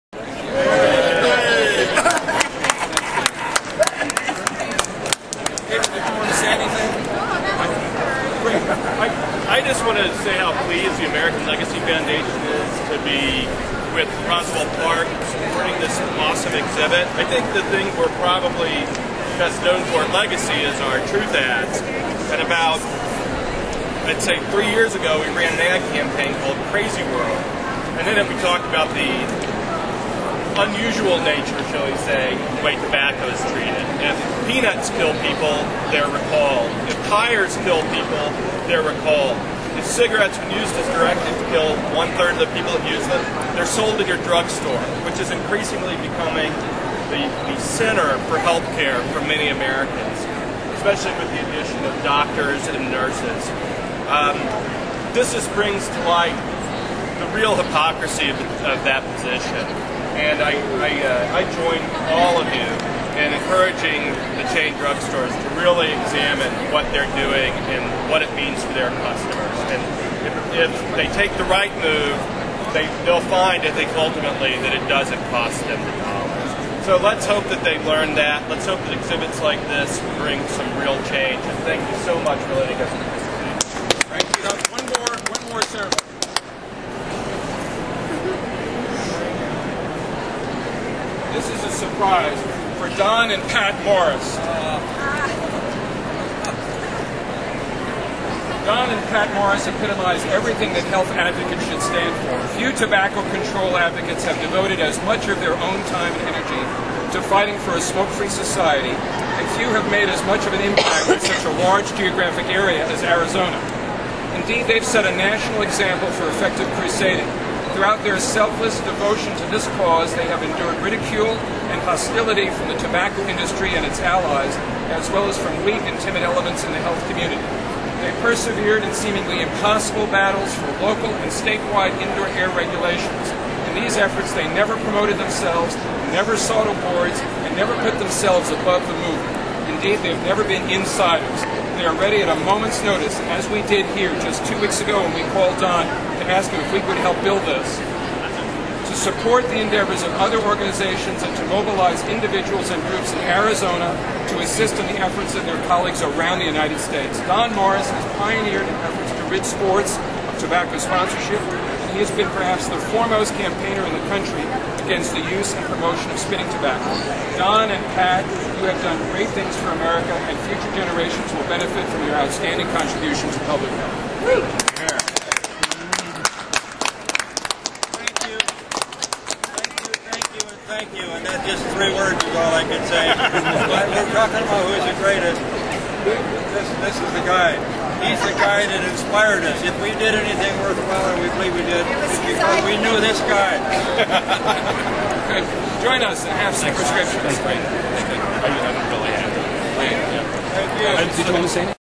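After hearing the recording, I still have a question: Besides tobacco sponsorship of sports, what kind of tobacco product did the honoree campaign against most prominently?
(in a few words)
spitting tobacco.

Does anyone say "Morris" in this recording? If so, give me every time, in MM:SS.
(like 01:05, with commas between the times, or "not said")
01:33, 01:39, 02:37.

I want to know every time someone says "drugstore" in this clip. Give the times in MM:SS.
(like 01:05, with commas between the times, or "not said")
00:44, 01:04.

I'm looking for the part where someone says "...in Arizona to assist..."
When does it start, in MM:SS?
02:33.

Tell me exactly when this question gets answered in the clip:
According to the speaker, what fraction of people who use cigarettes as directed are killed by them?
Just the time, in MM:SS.
00:41.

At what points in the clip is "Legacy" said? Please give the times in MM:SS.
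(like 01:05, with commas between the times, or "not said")
00:11, 00:20.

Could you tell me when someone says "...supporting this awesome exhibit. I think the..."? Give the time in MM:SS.
00:15.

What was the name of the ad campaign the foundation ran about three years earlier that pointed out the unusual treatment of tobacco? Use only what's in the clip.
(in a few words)
Crazy World.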